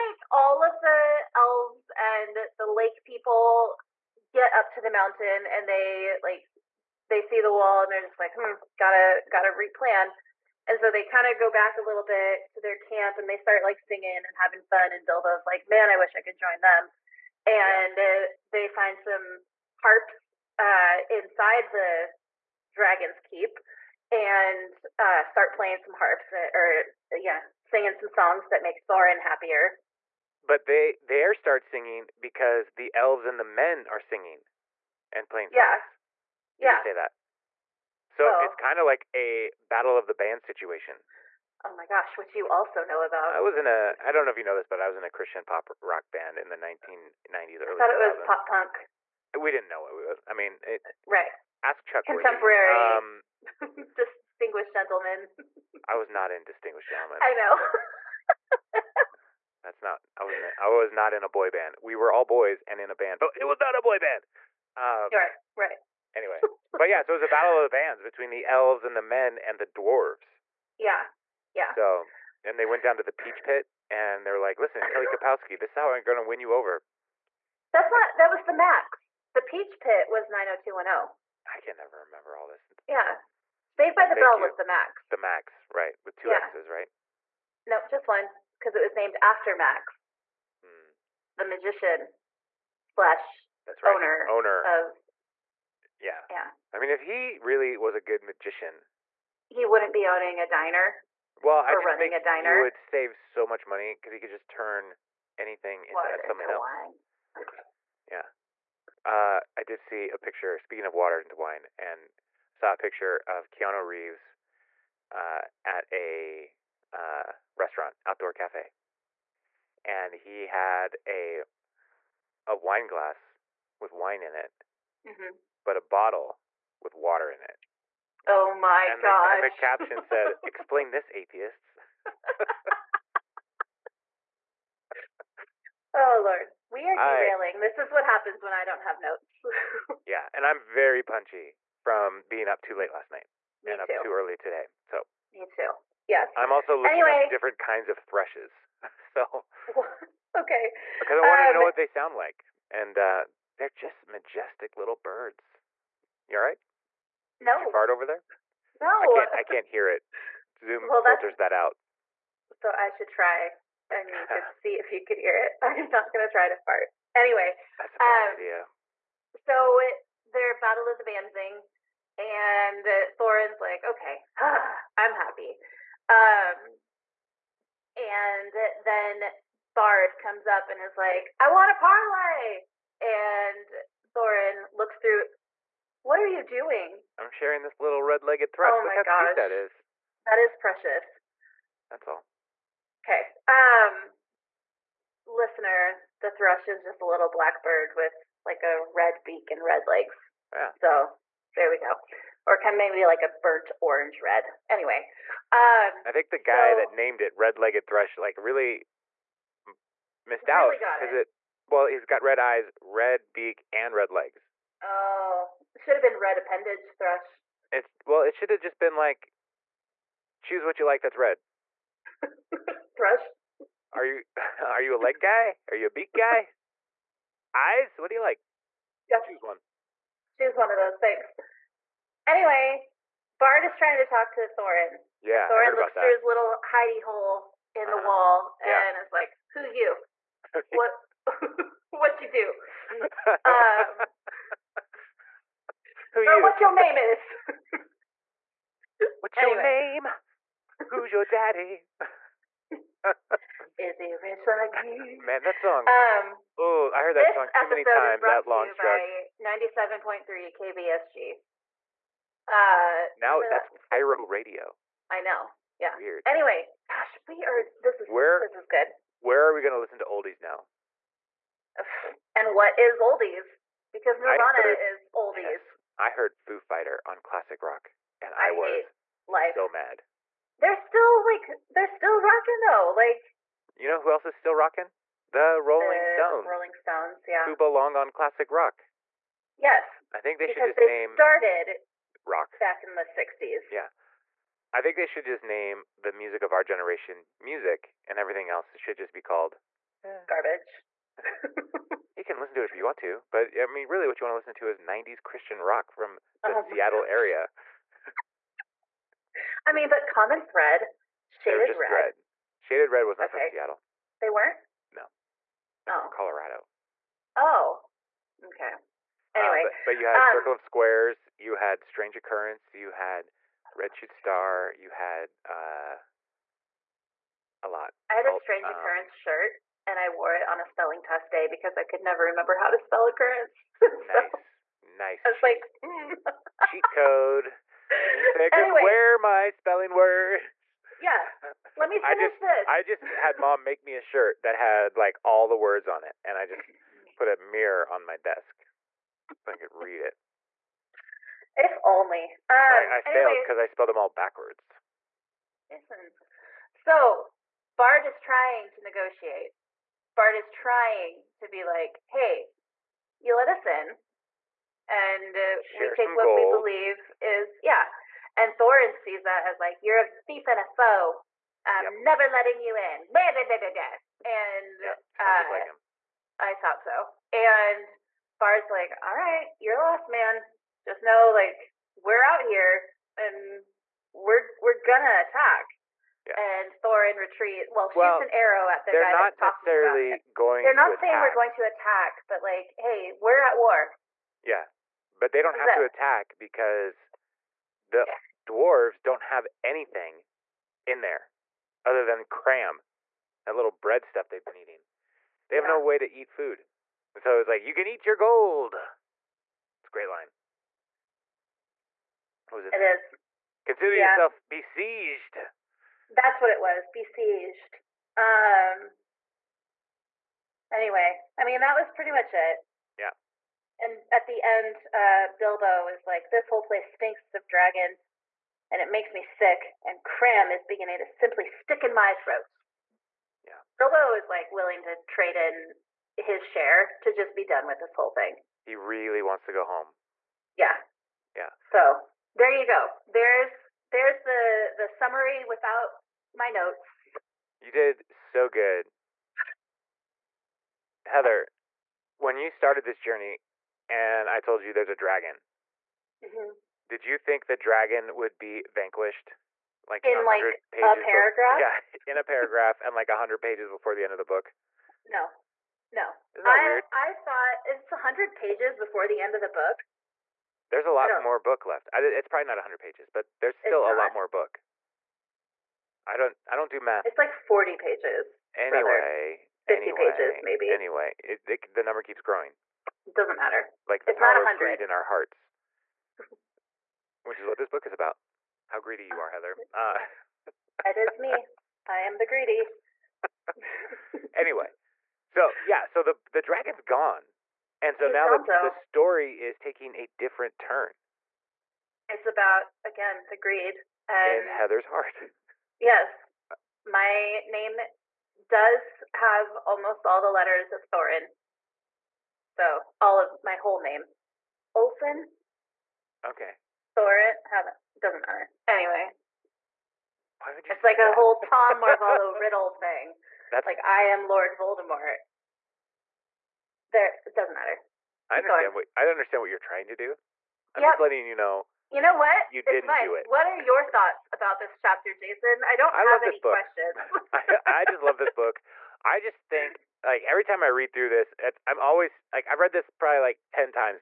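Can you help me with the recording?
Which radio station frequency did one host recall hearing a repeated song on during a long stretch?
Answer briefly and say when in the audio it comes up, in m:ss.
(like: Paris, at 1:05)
97.3 KBSG, at 4:19.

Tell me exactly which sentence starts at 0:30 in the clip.
But they there start singing because the elves and the men are singing and playing songs.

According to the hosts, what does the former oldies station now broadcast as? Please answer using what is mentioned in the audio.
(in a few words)
KIRO Radio.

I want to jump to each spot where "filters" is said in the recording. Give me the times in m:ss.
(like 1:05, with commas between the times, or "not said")
2:41.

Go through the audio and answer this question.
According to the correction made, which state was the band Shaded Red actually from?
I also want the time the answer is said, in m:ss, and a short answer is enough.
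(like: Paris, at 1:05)
Colorado, at 5:16.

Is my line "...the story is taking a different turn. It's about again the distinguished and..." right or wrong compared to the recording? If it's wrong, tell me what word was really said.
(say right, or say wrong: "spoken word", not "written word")
wrong: "greed", not "distinguished".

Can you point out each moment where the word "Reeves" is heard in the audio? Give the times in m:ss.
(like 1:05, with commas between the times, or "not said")
1:53.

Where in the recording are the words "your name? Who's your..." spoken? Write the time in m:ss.
4:09.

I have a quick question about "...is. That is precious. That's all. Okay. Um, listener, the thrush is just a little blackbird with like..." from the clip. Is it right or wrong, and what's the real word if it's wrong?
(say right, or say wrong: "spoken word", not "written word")
right.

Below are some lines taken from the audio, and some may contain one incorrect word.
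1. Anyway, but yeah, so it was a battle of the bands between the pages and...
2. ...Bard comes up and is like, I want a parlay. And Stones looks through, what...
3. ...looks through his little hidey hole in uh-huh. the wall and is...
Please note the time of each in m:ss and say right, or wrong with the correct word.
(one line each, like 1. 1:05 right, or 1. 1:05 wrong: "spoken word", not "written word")
1. 1:06 wrong: "elves", not "pages"
2. 2:59 wrong: "Thorin", not "Stones"
3. 3:55 right.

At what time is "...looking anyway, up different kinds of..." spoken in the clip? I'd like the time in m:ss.
2:26.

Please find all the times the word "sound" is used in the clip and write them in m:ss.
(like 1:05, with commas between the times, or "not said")
2:31, 6:15.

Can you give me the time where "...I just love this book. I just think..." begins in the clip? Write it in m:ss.
8:57.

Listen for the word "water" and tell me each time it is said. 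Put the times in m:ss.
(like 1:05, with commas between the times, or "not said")
1:45, 1:50, 2:06.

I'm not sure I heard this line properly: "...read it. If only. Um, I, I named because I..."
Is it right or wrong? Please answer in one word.
wrong.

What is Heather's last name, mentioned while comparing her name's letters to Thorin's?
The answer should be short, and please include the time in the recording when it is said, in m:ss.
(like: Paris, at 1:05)
Olson, at 8:34.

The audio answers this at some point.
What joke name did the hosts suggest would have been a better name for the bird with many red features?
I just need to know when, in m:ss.
3:36.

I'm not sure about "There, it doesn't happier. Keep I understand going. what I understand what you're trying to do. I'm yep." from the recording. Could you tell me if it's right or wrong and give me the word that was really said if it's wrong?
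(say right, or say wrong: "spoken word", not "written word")
wrong: "matter", not "happier".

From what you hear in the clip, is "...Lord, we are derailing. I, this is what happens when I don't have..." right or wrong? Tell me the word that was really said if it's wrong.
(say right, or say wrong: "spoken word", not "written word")
right.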